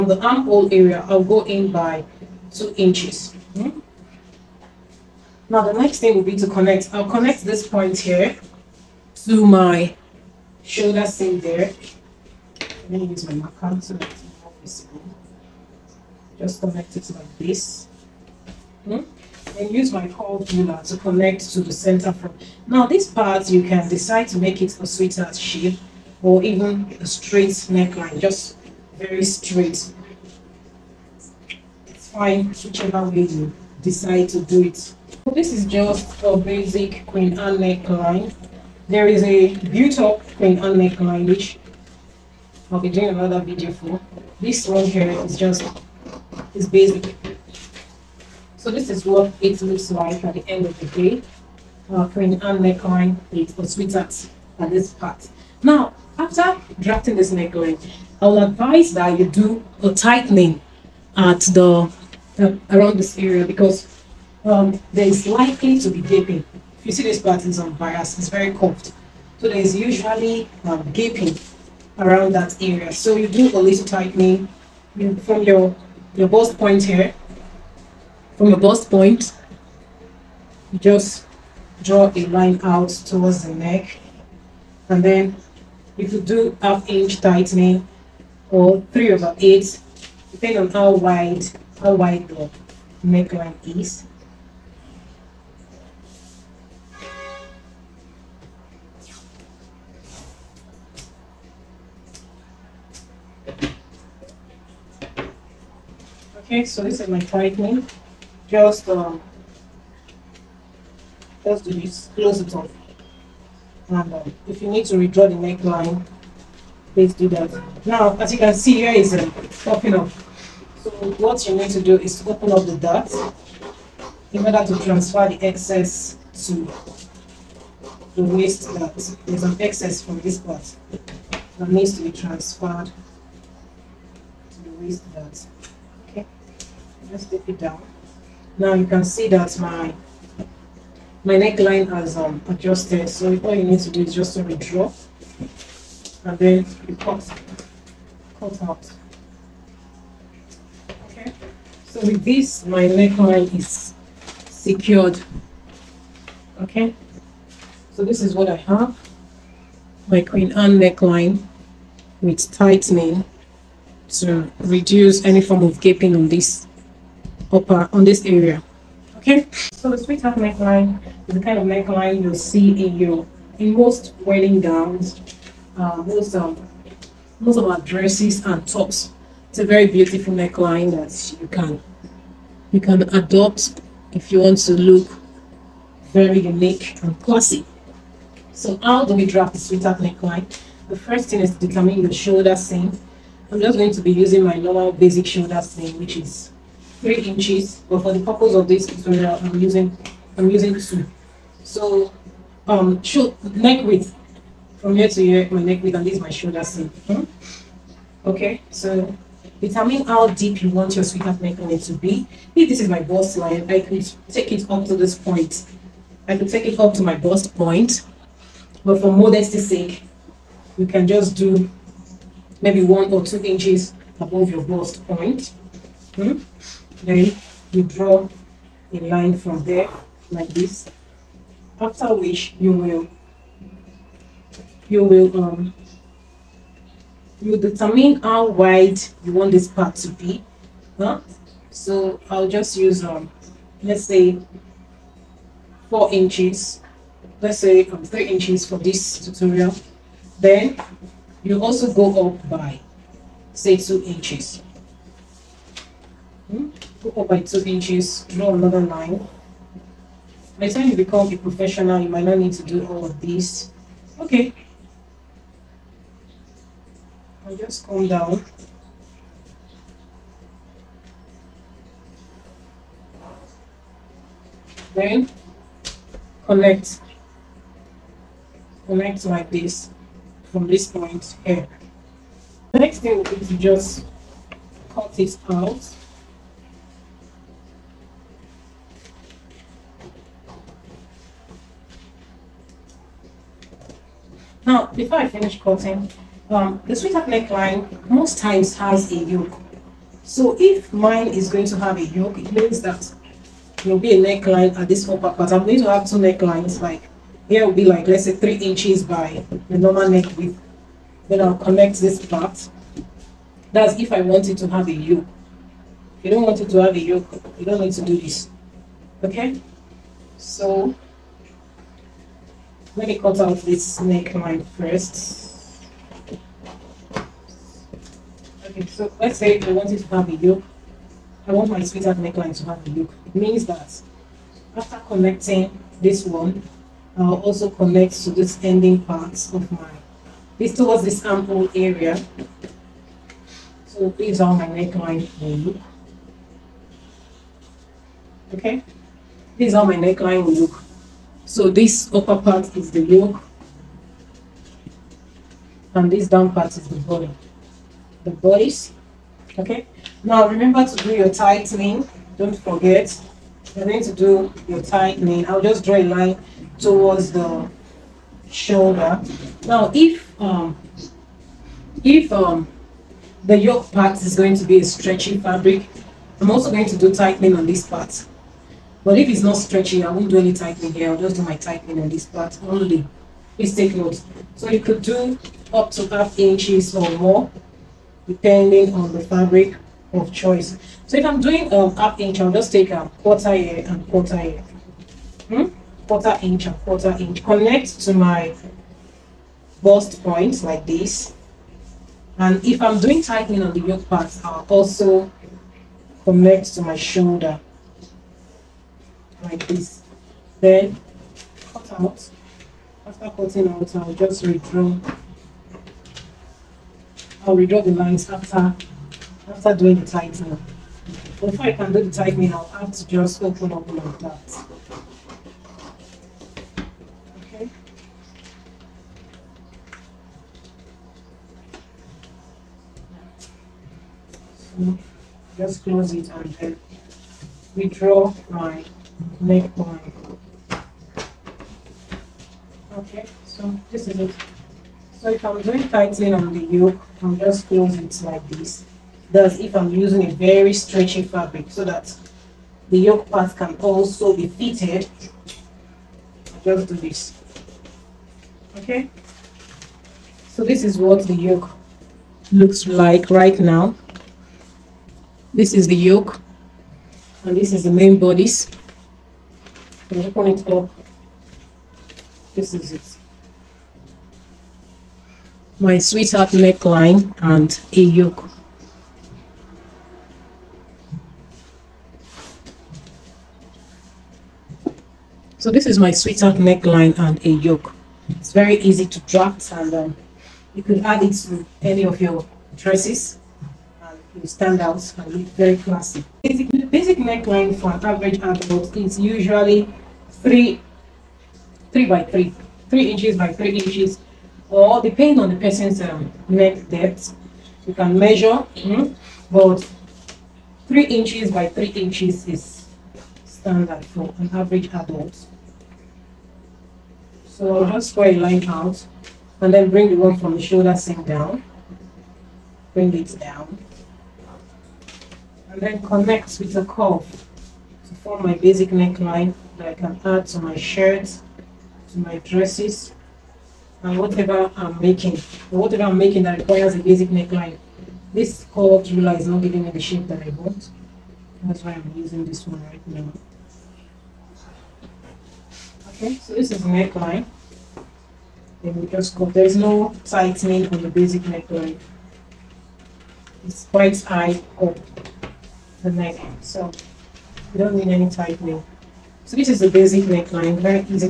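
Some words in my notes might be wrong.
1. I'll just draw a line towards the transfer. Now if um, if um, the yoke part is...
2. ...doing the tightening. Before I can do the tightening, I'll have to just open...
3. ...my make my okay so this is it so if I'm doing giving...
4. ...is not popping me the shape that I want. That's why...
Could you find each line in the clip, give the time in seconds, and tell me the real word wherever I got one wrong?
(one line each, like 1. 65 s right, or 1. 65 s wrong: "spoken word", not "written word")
1. 365 s wrong: "shoulder", not "transfer"
2. 419 s right
3. 438 s wrong: "tightening", not "giving"
4. 539 s wrong: "giving", not "popping".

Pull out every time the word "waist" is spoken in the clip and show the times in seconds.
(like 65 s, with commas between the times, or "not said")
128 s, 134 s.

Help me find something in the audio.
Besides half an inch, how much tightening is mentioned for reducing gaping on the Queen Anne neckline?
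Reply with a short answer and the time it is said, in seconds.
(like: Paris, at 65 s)
3/8 inch, at 88 s.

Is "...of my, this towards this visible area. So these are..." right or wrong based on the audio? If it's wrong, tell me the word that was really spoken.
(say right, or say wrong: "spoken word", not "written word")
wrong: "ample", not "visible".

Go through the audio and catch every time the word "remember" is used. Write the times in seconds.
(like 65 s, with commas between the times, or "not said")
360 s.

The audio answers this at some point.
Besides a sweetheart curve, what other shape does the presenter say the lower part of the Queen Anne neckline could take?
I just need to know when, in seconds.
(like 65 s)
27 s.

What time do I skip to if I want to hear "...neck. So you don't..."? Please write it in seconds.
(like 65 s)
556 s.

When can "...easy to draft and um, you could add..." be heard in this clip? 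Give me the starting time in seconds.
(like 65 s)
488 s.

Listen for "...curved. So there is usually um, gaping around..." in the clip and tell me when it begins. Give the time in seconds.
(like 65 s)
68 s.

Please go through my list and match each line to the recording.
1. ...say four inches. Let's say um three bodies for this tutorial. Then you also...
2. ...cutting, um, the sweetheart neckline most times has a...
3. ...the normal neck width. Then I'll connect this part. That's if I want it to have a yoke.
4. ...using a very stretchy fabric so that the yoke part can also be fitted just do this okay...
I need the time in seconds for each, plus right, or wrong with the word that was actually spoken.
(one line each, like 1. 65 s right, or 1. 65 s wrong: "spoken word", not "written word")
1. 244 s wrong: "inches", not "bodies"
2. 295 s right
3. 309 s right
4. 449 s right.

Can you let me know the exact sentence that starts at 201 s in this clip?
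So um should neck width from here to here, my neck width, and this is my shoulder seam.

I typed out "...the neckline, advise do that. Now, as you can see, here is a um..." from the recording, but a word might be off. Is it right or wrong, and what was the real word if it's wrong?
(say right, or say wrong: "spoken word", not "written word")
wrong: "please", not "advise".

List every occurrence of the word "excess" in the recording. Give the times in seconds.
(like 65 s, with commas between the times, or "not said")
125 s, 129 s.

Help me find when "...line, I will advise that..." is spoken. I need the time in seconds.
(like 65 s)
57 s.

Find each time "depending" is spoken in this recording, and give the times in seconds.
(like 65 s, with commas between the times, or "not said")
90 s, 388 s, 505 s.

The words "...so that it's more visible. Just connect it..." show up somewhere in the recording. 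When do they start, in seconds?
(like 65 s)
13 s.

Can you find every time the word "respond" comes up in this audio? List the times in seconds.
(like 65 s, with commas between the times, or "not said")
not said.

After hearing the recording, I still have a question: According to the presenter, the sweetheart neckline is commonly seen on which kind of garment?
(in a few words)
wedding gowns.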